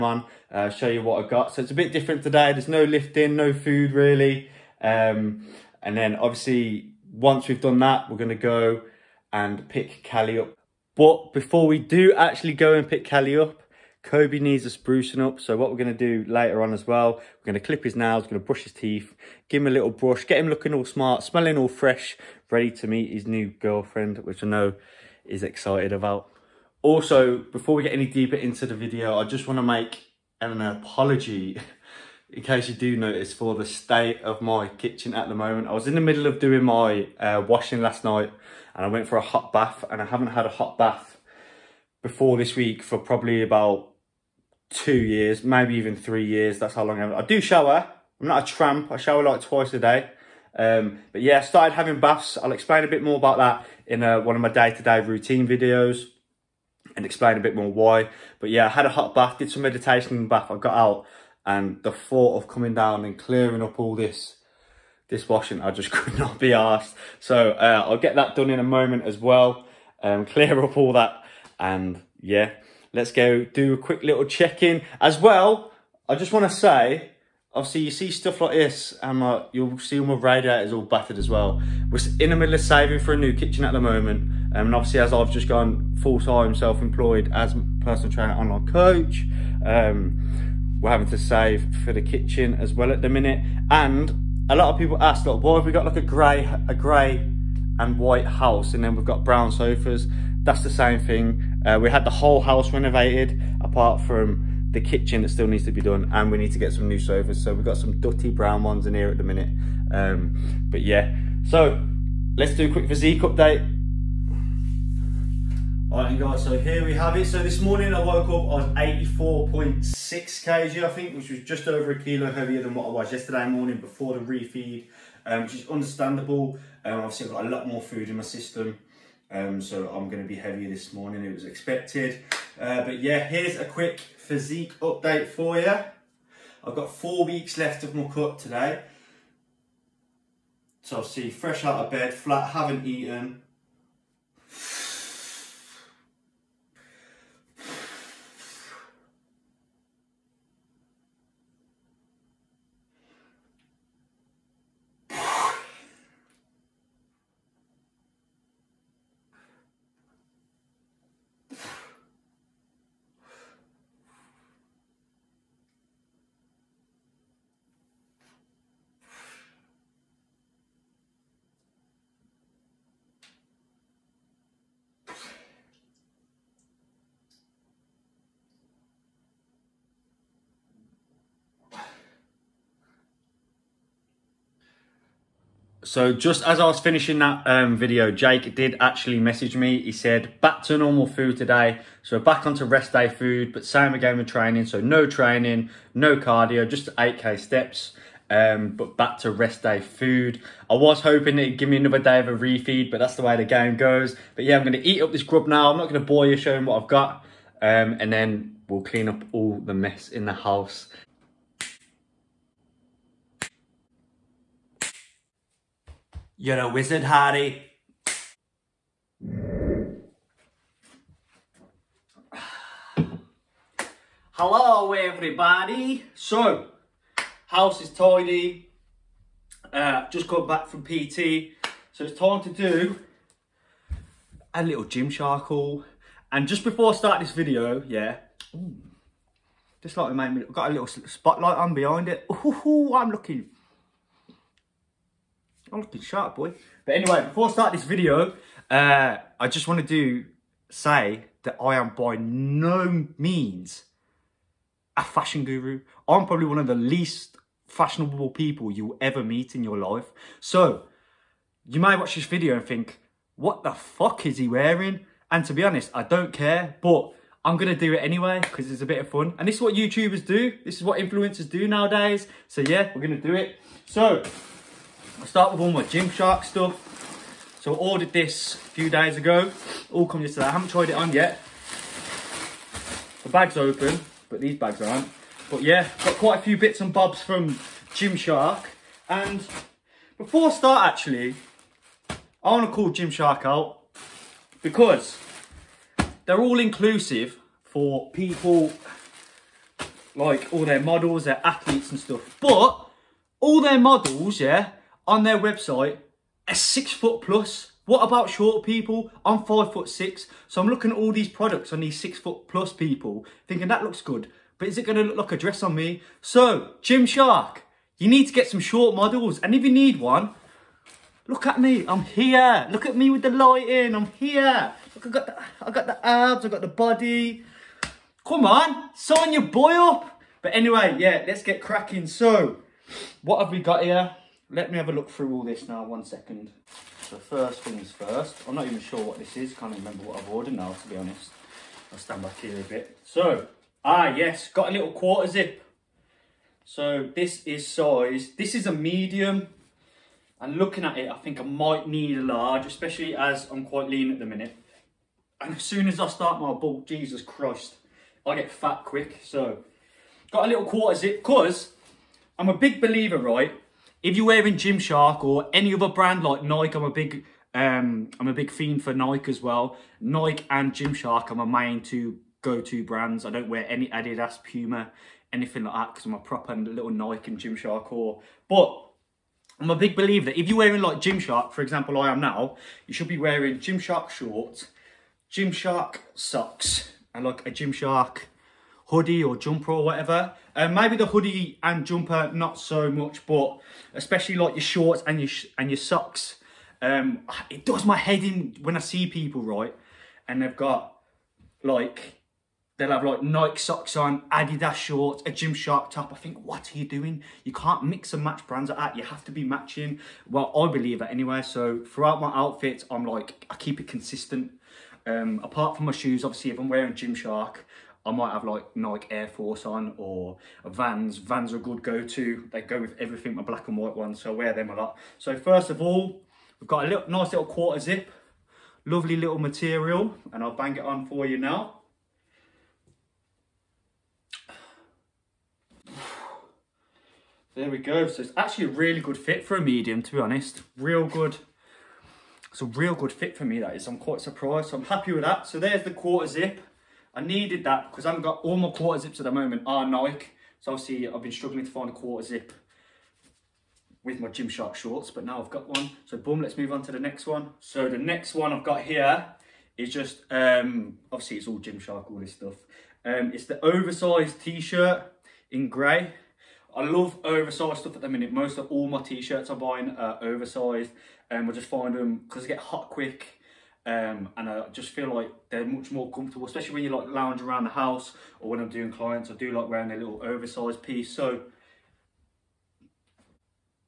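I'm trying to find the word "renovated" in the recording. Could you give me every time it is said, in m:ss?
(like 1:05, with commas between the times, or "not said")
1:42.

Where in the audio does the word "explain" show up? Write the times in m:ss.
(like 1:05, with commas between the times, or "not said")
0:52, 0:57.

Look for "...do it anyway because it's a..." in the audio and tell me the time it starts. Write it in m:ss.
4:27.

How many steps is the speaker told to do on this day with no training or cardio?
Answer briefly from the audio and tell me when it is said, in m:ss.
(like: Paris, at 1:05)
8K, at 3:16.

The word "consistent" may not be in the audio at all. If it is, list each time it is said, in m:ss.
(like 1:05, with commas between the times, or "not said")
6:53.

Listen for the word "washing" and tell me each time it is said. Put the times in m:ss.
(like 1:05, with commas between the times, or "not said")
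0:37, 1:05.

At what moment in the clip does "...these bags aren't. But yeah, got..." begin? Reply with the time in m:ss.
4:44.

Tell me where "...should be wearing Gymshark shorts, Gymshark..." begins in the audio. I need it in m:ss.
6:22.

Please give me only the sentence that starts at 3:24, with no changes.
But yeah, I'm going to eat up this grub now.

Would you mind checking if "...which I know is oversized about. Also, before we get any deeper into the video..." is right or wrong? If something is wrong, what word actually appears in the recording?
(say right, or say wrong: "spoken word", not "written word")
wrong: "excited", not "oversized".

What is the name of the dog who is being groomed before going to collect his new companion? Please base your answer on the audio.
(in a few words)
Kobe.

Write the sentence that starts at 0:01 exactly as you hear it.
So it's a bit different today.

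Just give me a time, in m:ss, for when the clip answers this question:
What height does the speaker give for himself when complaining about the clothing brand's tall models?
5:09.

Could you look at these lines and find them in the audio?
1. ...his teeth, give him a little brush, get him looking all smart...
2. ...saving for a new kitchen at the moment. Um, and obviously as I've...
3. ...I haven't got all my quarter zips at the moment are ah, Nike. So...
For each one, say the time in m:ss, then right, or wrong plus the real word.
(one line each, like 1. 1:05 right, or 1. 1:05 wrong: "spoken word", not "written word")
1. 0:18 right
2. 1:22 right
3. 7:28 right.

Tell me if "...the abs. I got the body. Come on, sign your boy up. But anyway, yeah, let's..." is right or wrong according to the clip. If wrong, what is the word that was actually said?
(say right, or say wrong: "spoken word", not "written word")
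right.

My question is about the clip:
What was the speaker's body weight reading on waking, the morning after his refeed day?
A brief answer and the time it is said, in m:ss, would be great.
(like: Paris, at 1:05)
84.6 kg, at 1:59.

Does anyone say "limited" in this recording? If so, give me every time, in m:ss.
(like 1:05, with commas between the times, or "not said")
not said.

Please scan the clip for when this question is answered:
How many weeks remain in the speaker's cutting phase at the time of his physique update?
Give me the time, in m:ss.
2:16.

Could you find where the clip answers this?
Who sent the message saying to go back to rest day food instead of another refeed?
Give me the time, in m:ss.
3:08.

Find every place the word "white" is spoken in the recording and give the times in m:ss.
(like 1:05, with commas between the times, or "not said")
1:37, 7:03.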